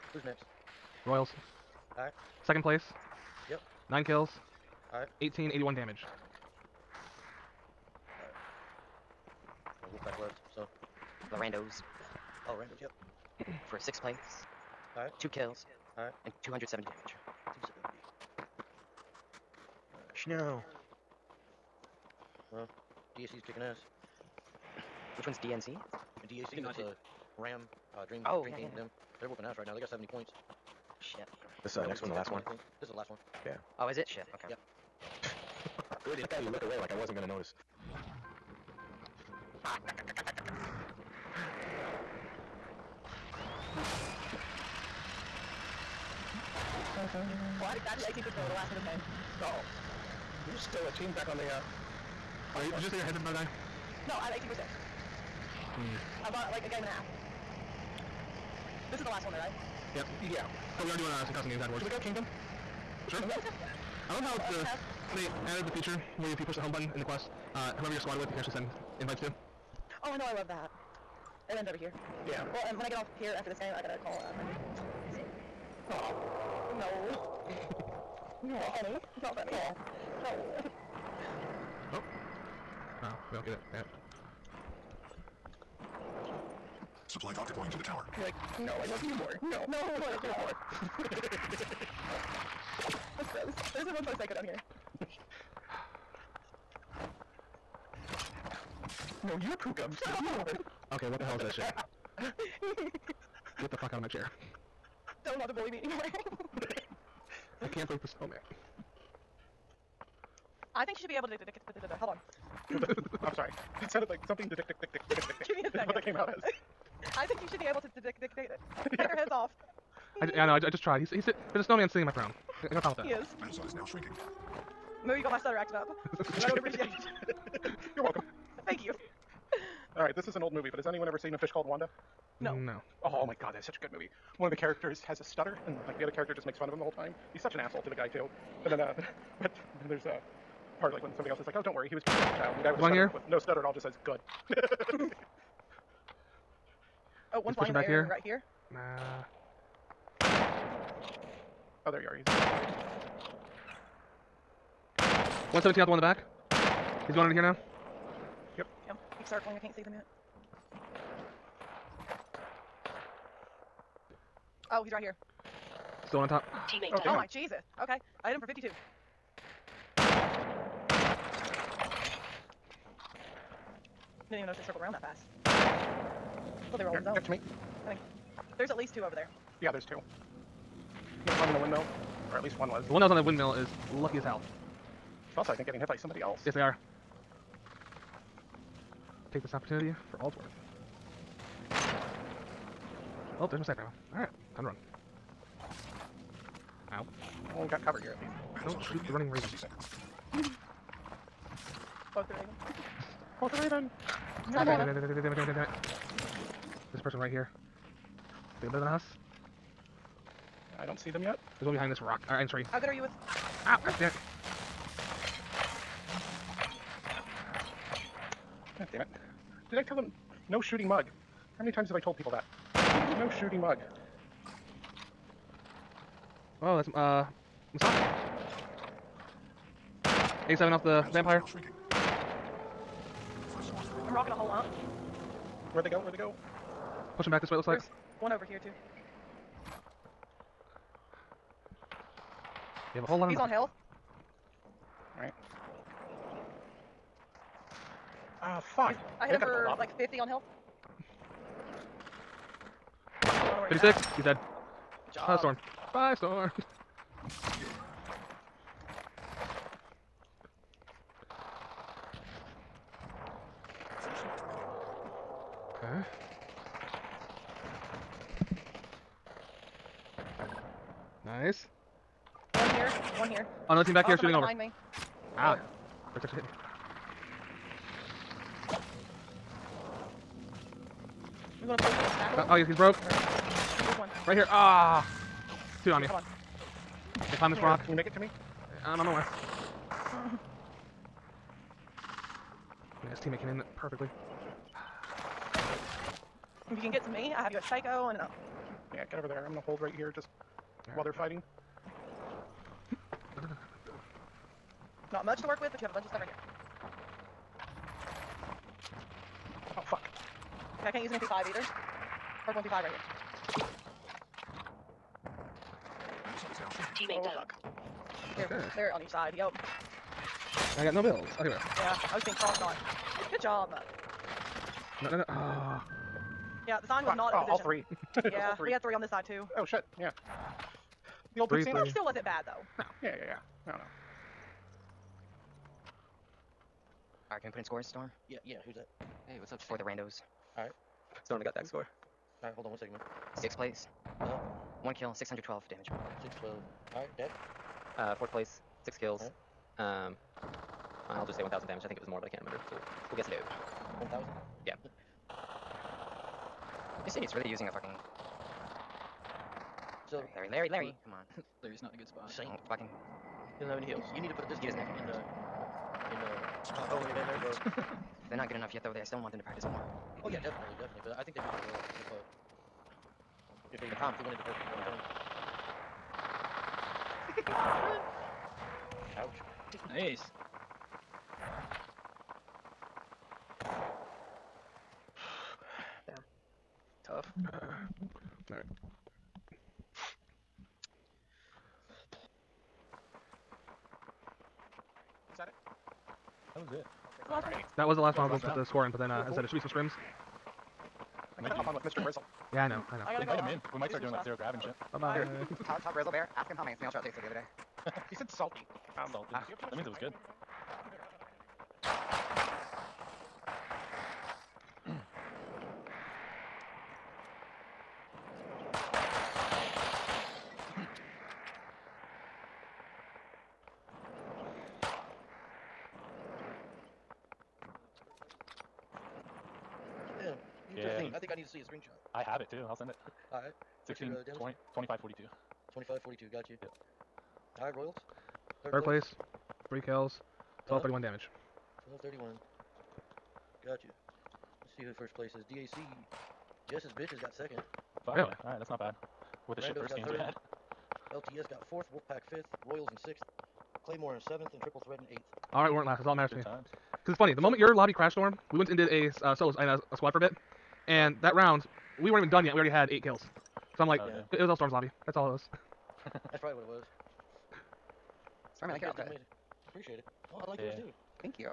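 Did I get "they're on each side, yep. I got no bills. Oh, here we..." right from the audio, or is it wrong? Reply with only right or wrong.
right.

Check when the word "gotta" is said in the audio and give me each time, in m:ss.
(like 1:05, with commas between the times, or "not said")
1:13, 6:41.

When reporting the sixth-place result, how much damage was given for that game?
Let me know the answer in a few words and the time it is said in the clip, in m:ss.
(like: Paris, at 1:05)
612, at 5:45.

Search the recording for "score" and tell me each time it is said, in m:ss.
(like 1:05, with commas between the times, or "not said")
5:37, 5:41, 6:38.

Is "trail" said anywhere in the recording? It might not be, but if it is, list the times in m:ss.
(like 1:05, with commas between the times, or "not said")
6:46.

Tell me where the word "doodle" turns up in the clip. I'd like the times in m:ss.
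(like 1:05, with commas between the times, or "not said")
not said.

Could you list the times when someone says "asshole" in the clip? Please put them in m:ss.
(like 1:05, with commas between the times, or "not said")
2:17.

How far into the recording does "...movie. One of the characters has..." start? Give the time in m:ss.
2:13.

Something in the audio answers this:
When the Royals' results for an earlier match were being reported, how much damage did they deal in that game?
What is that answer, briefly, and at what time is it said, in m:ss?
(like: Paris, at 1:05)
1881, at 0:05.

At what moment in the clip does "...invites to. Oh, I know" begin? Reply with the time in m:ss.
1:09.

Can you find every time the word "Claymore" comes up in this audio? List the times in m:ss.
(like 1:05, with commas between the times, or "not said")
7:33.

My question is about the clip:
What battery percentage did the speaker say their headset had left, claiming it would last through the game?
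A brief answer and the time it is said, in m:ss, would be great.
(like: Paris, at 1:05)
18%, at 0:47.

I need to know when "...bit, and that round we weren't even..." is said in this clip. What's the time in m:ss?
7:40.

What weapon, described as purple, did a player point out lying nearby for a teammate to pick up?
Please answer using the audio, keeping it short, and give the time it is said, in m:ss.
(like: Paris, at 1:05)
MP5, at 5:12.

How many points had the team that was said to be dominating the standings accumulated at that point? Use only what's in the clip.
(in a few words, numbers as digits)
70.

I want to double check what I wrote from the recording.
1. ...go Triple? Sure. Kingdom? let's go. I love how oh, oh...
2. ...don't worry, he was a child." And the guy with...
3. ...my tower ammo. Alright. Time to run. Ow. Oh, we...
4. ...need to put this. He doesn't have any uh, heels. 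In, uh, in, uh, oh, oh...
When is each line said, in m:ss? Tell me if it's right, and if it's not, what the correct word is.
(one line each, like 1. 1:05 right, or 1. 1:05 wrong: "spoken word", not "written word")
1. 1:01 wrong: "Kingdom", not "Triple"
2. 2:21 right
3. 3:13 wrong: "sniper", not "tower"
4. 6:04 right.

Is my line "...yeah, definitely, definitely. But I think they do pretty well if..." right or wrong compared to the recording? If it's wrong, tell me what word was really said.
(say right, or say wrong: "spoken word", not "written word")
right.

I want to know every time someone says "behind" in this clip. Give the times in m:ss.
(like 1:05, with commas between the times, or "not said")
3:31, 4:34.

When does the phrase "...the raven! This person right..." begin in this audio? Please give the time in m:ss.
3:23.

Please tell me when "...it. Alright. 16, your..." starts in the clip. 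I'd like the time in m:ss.
7:12.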